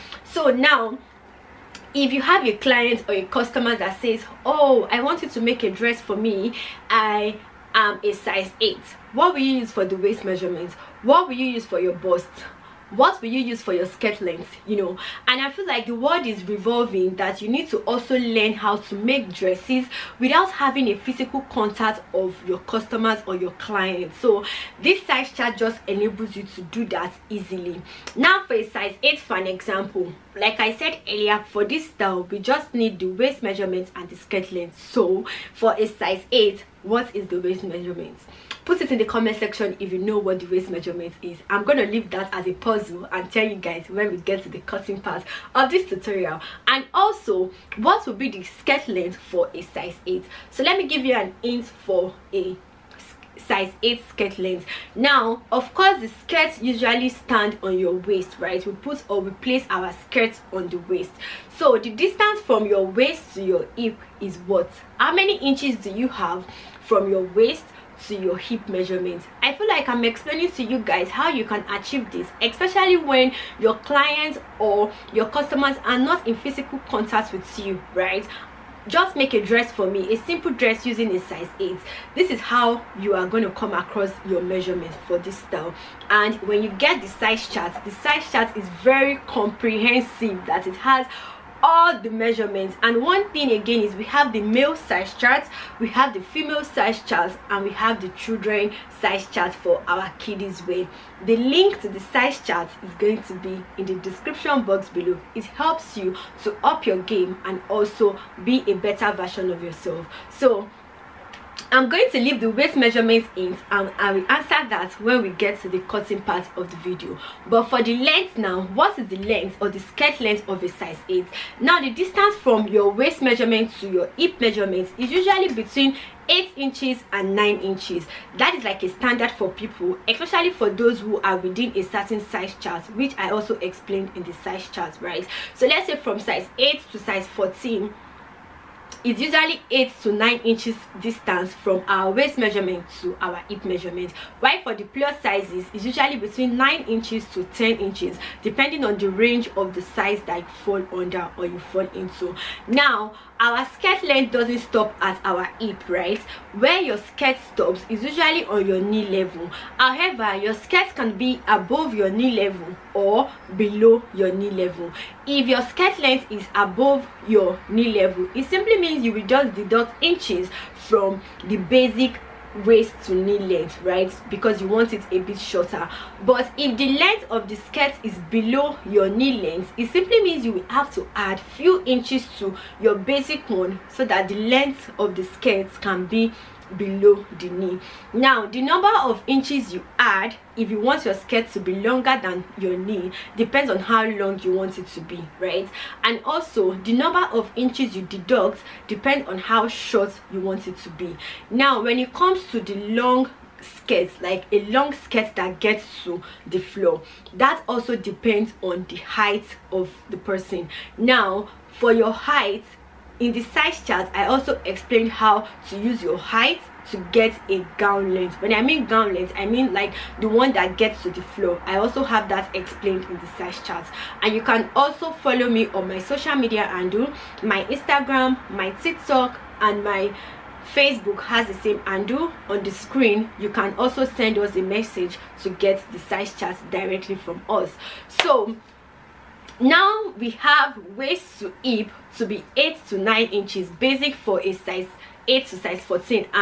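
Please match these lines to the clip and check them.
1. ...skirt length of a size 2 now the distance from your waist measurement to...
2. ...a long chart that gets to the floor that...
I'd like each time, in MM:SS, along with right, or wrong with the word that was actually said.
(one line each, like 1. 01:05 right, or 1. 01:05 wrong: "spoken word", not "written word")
1. 01:59 wrong: "8", not "2"
2. 03:24 wrong: "skirt", not "chart".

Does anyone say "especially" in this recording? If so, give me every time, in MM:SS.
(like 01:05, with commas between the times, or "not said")
01:12, 02:10.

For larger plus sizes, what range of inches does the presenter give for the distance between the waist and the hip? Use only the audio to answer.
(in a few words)
9 to 10 inches.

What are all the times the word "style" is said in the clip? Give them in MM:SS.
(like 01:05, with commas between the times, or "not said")
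00:31, 01:25.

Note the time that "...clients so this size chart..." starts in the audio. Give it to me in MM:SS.
00:23.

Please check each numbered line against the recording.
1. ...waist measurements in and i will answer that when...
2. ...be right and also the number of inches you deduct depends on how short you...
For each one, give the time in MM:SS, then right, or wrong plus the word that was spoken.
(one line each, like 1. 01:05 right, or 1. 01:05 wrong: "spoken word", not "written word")
1. 01:52 right
2. 03:15 right.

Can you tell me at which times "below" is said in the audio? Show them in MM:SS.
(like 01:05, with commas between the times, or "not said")
01:44, 02:43, 02:58, 03:06.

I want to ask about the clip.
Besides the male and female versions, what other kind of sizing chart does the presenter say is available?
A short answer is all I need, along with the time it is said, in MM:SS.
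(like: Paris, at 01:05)
children size chart, at 01:38.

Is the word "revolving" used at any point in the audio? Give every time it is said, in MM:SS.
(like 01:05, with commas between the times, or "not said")
00:16.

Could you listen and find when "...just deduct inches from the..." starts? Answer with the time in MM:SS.
02:49.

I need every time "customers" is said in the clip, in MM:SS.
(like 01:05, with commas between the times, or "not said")
00:03, 00:22, 01:15.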